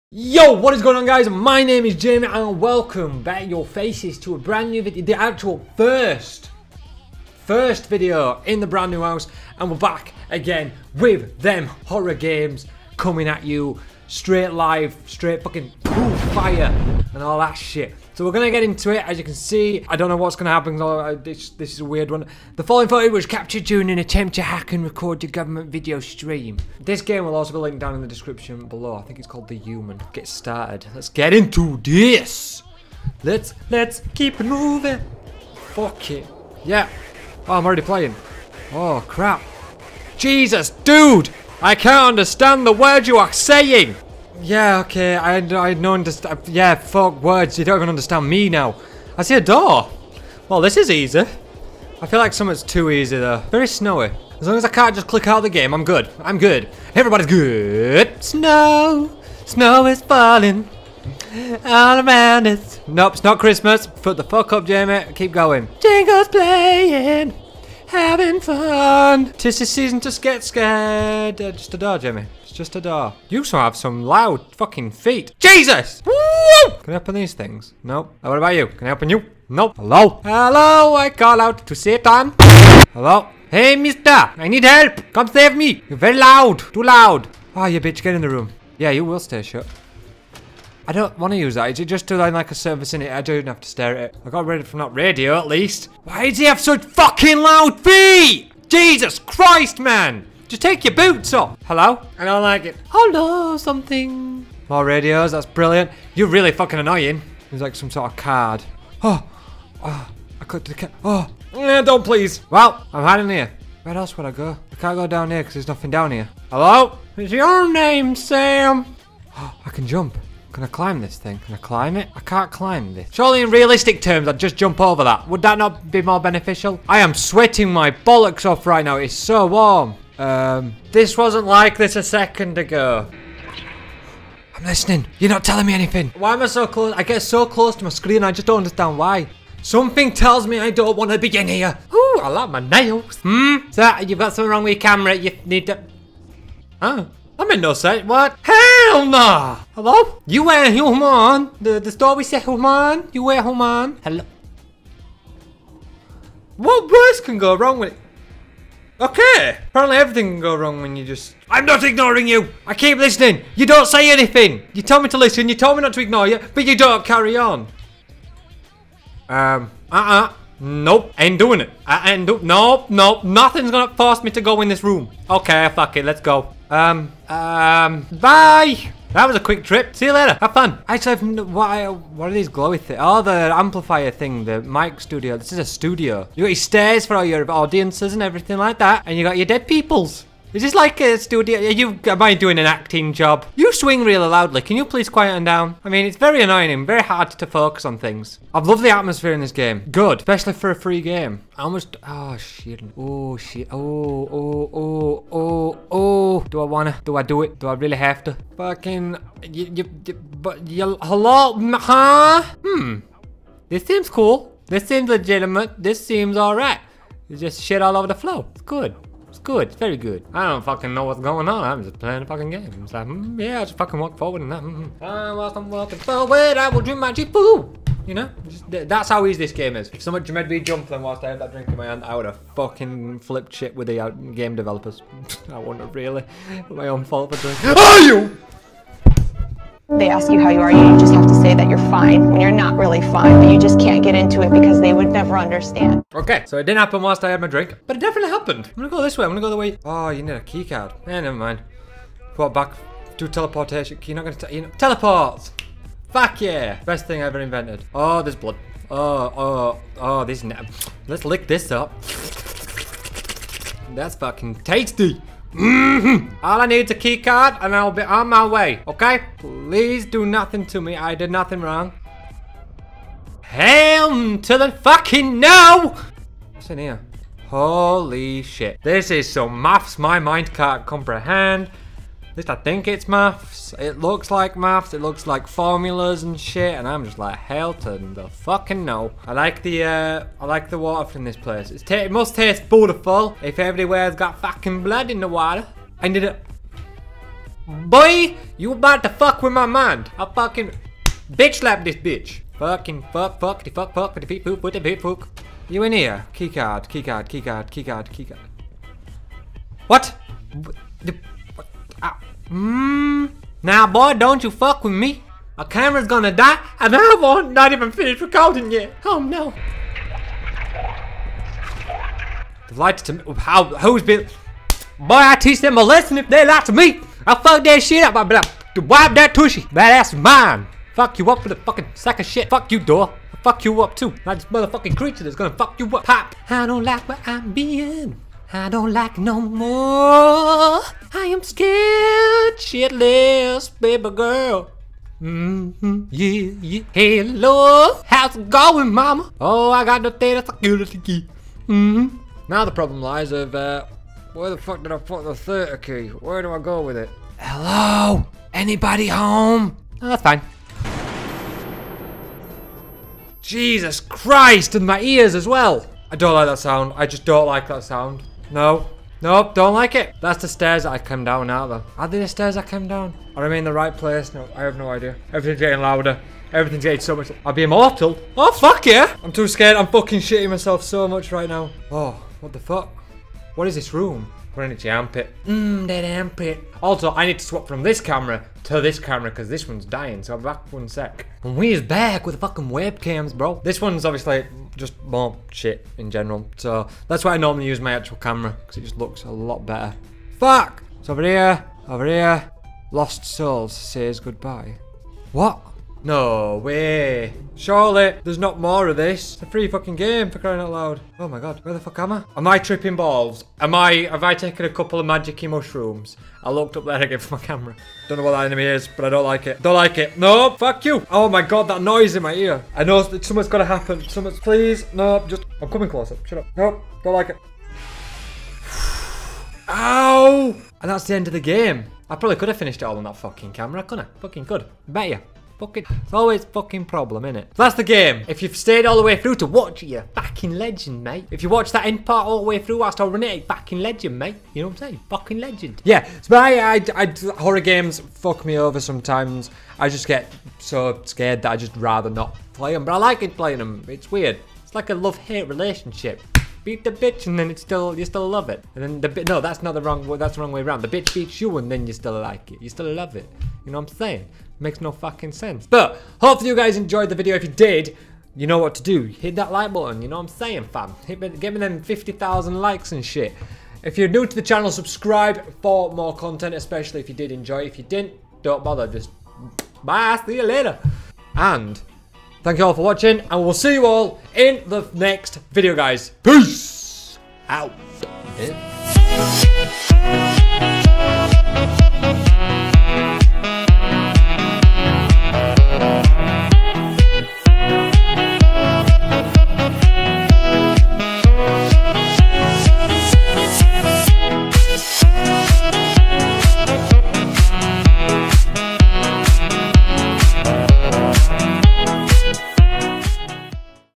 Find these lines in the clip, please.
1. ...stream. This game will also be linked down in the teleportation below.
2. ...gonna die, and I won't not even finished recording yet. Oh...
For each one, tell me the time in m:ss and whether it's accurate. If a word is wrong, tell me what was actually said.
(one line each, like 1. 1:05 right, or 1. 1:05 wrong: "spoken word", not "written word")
1. 0:26 wrong: "description", not "teleportation"
2. 5:16 right.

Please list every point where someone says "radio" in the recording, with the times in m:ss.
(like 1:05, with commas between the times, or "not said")
1:34, 1:44.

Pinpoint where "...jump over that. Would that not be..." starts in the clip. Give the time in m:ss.
2:04.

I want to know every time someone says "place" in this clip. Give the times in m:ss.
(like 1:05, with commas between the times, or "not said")
4:51, 6:13.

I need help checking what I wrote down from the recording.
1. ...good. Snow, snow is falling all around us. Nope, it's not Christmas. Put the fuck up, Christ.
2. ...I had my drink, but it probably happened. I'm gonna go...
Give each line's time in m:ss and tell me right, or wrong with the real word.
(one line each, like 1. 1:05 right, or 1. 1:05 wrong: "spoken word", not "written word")
1. 0:57 wrong: "Jamie", not "Christ"
2. 4:07 wrong: "definitely", not "probably".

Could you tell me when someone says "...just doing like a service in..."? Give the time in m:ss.
1:31.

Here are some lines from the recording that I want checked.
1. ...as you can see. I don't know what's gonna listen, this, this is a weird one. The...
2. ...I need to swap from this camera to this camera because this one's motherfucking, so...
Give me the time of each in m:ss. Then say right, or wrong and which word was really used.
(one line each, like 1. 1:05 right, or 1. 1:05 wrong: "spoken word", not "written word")
1. 0:19 wrong: "happen", not "listen"
2. 6:27 wrong: "dying", not "motherfucking".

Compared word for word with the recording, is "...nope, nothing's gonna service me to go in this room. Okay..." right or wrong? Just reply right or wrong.
wrong.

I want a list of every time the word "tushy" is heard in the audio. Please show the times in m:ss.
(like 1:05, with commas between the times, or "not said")
5:29.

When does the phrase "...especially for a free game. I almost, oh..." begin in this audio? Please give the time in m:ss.
3:20.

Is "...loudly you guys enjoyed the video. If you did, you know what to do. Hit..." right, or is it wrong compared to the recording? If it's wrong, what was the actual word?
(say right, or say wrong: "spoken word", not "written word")
wrong: "hopefully", not "loudly".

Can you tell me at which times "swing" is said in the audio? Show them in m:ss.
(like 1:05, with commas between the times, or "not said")
3:13.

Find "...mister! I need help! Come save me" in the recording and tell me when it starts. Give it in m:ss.
1:23.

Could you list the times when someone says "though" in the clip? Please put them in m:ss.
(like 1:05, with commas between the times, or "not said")
0:53.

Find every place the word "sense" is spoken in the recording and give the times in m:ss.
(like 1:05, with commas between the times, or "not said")
2:27, 7:45.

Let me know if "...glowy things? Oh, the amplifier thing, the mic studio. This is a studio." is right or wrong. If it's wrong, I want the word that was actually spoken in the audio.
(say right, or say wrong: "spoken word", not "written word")
right.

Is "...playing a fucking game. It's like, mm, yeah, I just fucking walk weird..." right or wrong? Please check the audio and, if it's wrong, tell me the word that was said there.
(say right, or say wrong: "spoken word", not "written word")
wrong: "forward", not "weird".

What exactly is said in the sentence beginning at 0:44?
Yeah, okay, I, I don't understand.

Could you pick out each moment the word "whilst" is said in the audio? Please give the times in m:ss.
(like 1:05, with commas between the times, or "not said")
3:51, 4:07, 7:22.